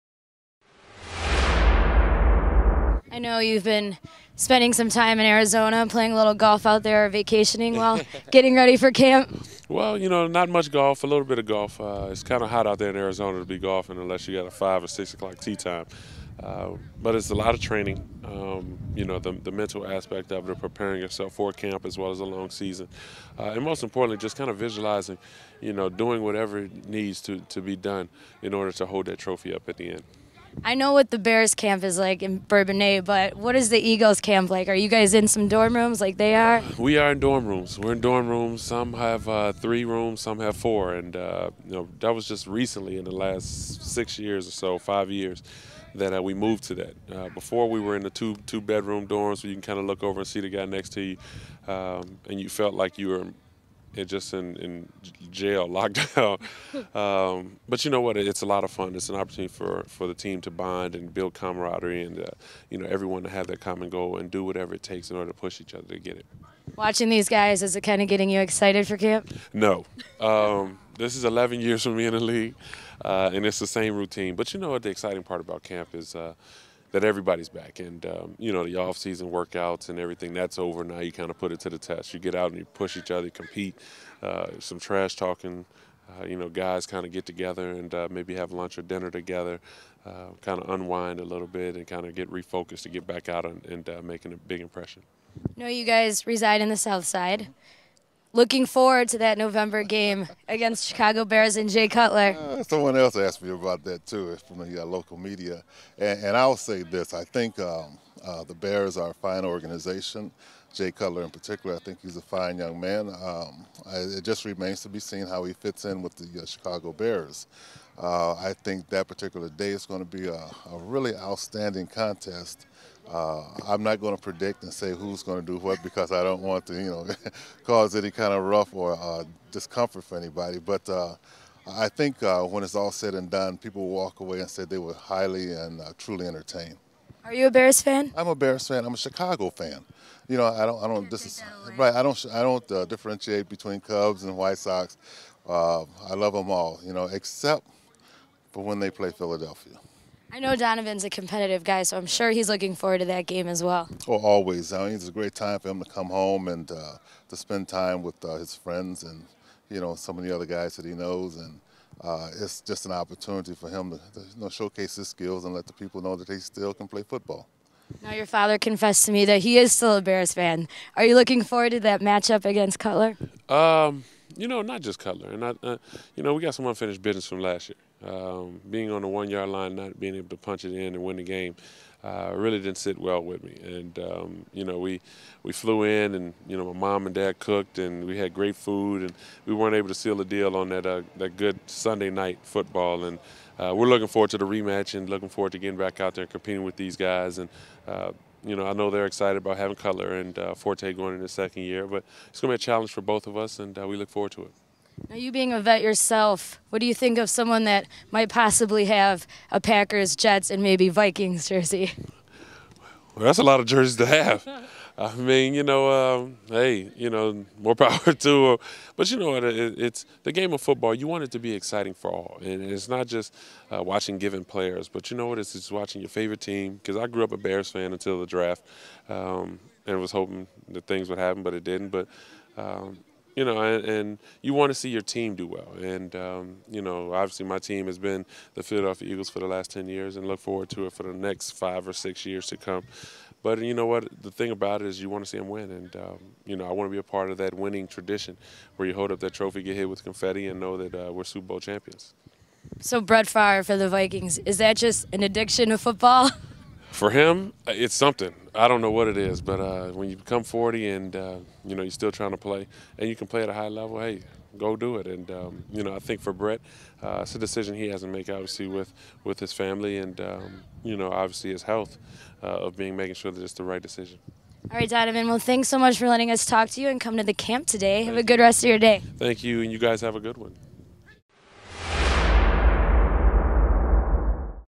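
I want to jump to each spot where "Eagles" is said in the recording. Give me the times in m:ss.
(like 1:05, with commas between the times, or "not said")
0:33, 3:59.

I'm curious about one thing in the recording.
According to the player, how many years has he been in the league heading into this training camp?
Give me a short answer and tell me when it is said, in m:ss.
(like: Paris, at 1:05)
11, at 1:11.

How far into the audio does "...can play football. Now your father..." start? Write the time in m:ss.
2:46.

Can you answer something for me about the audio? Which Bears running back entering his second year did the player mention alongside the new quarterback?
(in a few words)
Forte.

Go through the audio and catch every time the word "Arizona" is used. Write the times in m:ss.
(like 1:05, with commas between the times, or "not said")
0:05, 0:12.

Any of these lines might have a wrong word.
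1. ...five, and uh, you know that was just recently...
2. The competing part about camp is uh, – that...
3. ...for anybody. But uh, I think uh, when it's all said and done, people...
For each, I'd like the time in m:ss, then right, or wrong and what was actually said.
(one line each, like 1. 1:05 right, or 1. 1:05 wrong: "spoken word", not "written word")
1. 0:40 wrong: "four", not "five"
2. 1:14 wrong: "exciting", not "competing"
3. 2:10 right.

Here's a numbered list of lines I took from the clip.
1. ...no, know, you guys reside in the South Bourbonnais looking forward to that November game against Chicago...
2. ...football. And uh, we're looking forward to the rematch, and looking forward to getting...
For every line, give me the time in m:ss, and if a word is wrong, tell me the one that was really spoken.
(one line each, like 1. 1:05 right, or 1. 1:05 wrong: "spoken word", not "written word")
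1. 1:35 wrong: "Side", not "Bourbonnais"
2. 3:12 right.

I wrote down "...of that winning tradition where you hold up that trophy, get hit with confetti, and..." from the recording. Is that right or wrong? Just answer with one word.
right.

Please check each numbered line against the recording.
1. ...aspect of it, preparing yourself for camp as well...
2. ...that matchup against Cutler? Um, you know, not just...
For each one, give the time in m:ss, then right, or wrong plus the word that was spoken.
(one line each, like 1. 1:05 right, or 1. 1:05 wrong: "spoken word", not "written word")
1. 0:19 right
2. 2:51 right.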